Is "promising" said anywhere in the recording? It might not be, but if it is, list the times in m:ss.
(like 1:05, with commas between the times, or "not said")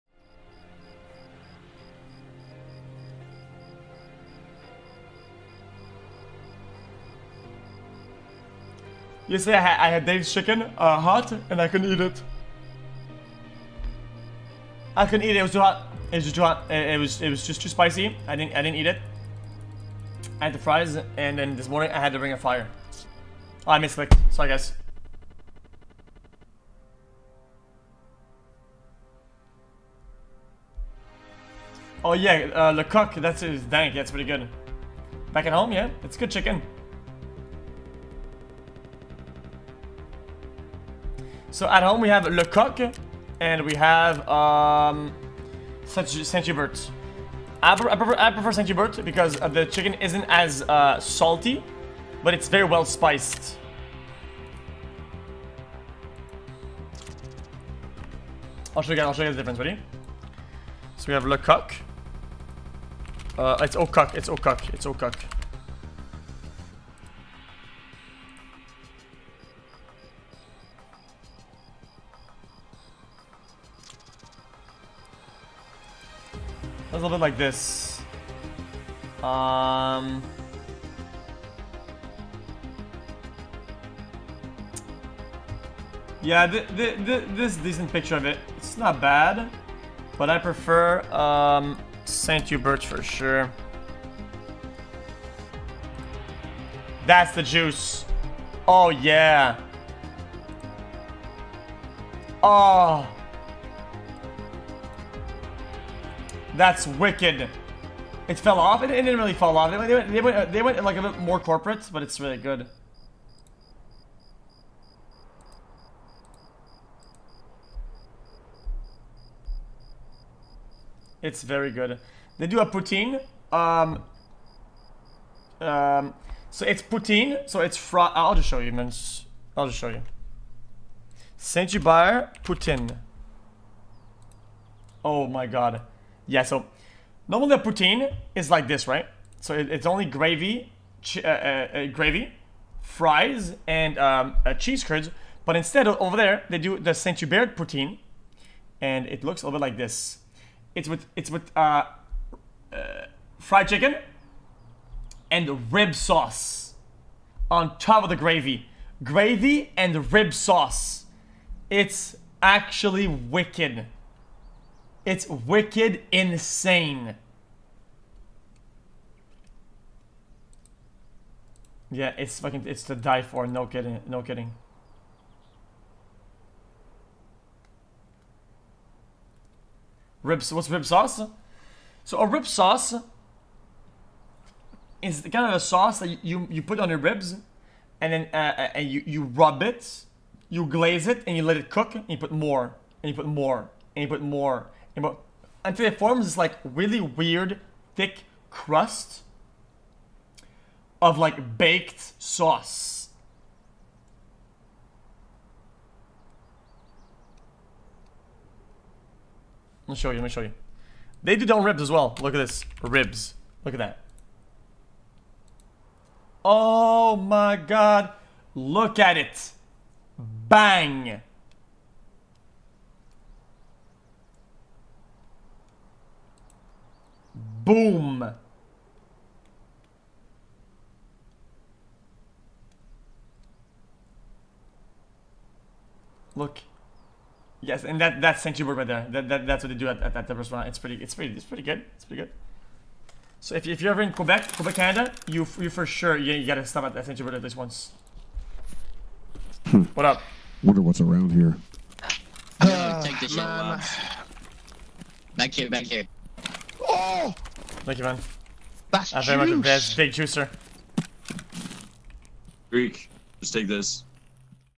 not said.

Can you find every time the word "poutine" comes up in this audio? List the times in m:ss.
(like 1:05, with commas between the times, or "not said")
2:02, 2:06, 2:12, 2:17, 2:27.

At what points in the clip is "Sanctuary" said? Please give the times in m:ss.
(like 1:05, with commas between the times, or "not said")
3:58, 4:07.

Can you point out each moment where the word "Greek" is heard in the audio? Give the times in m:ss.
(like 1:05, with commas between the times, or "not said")
4:22.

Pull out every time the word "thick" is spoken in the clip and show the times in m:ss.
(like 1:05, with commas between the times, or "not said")
3:17.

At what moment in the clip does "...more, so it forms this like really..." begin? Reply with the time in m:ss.
3:14.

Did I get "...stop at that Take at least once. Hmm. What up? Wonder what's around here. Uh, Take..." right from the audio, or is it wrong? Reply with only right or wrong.
wrong.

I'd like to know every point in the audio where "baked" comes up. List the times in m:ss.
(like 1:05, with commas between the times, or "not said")
3:21.